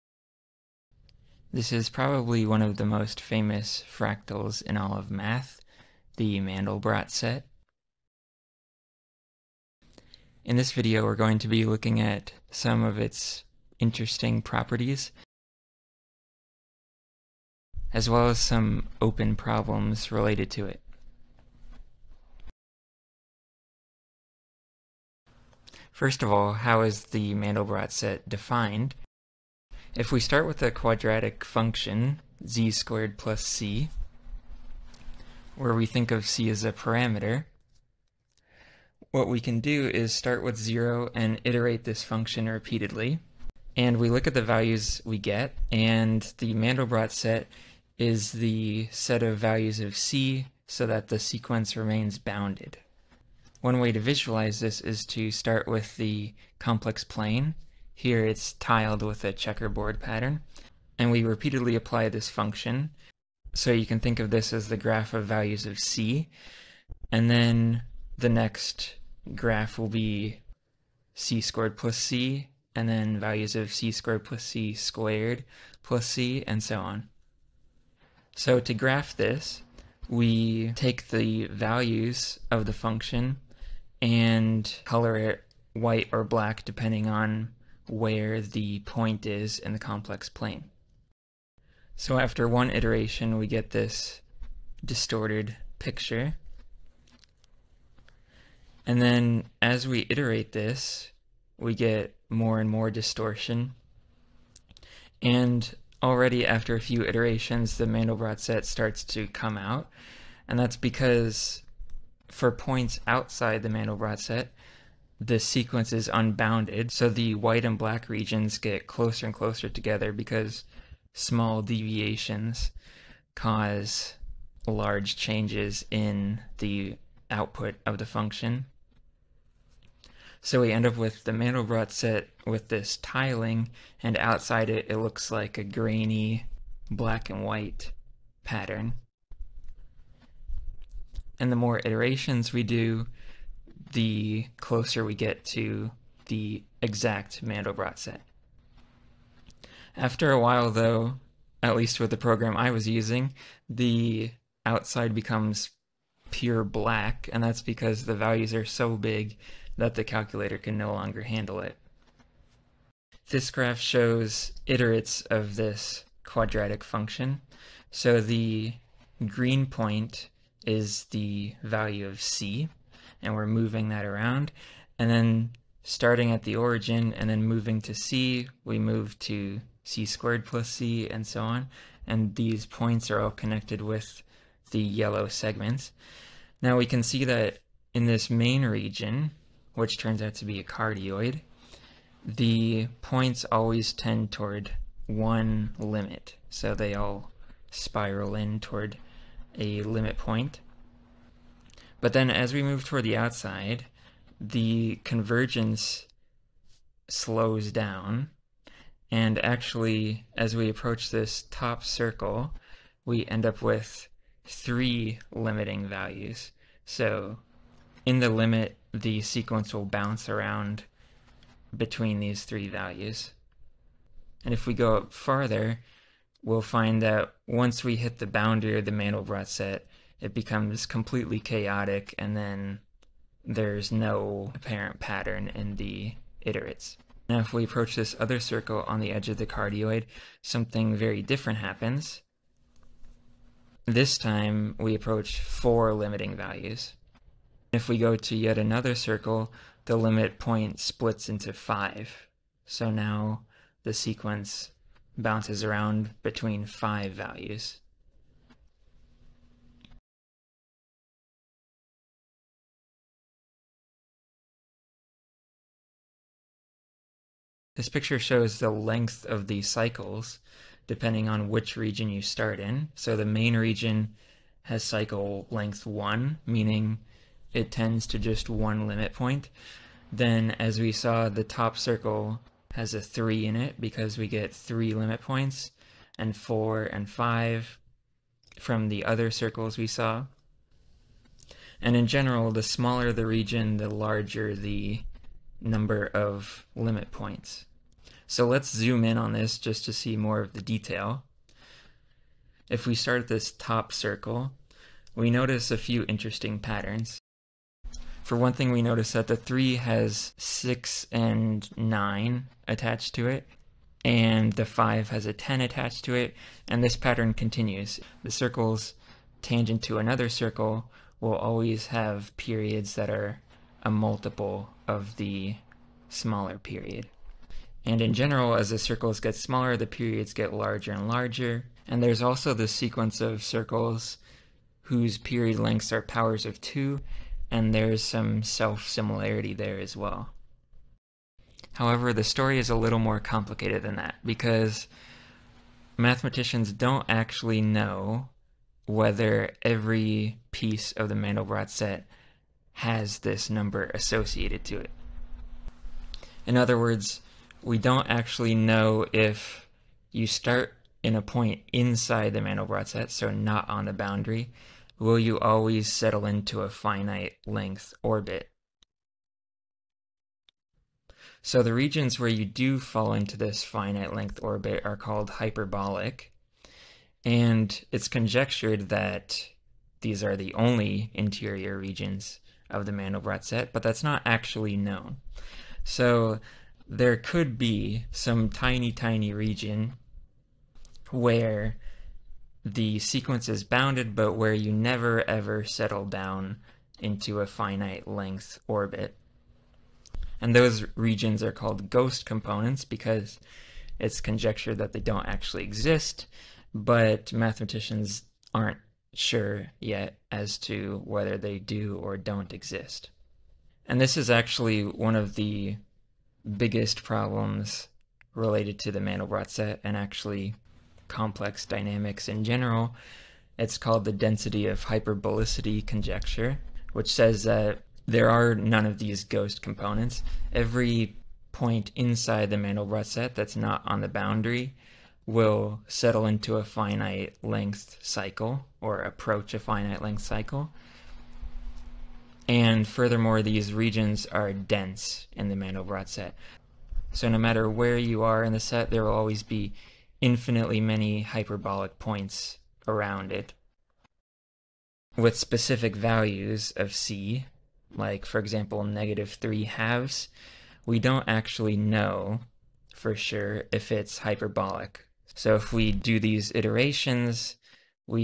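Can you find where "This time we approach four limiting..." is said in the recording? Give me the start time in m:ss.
4:03.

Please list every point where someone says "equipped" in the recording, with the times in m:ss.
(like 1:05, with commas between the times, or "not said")
not said.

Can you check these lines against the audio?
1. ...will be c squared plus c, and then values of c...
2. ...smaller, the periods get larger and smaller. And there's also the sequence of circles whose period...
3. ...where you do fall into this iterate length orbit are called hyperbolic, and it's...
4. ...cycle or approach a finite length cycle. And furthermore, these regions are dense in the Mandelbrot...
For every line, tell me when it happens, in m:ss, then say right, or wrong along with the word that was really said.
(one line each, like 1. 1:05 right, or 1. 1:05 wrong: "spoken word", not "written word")
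1. 1:09 right
2. 5:29 wrong: "larger", not "smaller"
3. 6:12 wrong: "finite", not "iterate"
4. 7:18 right.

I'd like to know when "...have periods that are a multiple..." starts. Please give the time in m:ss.
5:21.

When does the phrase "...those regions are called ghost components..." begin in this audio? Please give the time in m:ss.
6:40.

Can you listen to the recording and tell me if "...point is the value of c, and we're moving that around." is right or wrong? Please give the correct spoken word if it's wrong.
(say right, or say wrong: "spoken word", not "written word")
right.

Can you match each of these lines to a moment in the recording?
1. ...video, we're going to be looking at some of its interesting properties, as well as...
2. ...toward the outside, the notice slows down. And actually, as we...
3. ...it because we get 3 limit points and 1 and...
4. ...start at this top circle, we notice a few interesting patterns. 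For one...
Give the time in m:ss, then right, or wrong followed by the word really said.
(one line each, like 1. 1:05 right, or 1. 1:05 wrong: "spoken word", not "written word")
1. 0:10 right
2. 3:22 wrong: "convergence", not "notice"
3. 4:43 wrong: "4", not "1"
4. 5:02 right.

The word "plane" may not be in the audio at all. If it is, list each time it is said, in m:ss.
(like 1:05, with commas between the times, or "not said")
0:57, 1:30.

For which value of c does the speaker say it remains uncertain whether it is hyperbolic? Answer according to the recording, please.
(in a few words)
-3/2.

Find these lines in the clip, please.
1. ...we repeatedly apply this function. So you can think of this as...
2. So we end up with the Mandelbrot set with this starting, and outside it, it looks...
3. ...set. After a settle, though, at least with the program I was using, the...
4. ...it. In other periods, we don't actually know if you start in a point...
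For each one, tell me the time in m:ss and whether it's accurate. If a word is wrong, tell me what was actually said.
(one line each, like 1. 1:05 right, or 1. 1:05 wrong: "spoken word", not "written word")
1. 1:01 right
2. 2:10 wrong: "tiling", not "starting"
3. 2:27 wrong: "while", not "settle"
4. 5:54 wrong: "words", not "periods".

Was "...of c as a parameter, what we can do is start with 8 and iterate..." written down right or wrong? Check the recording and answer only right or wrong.
wrong.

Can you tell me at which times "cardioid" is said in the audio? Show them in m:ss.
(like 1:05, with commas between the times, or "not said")
3:10, 3:59.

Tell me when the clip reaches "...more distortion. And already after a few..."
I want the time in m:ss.
1:42.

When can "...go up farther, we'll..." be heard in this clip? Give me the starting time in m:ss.
3:44.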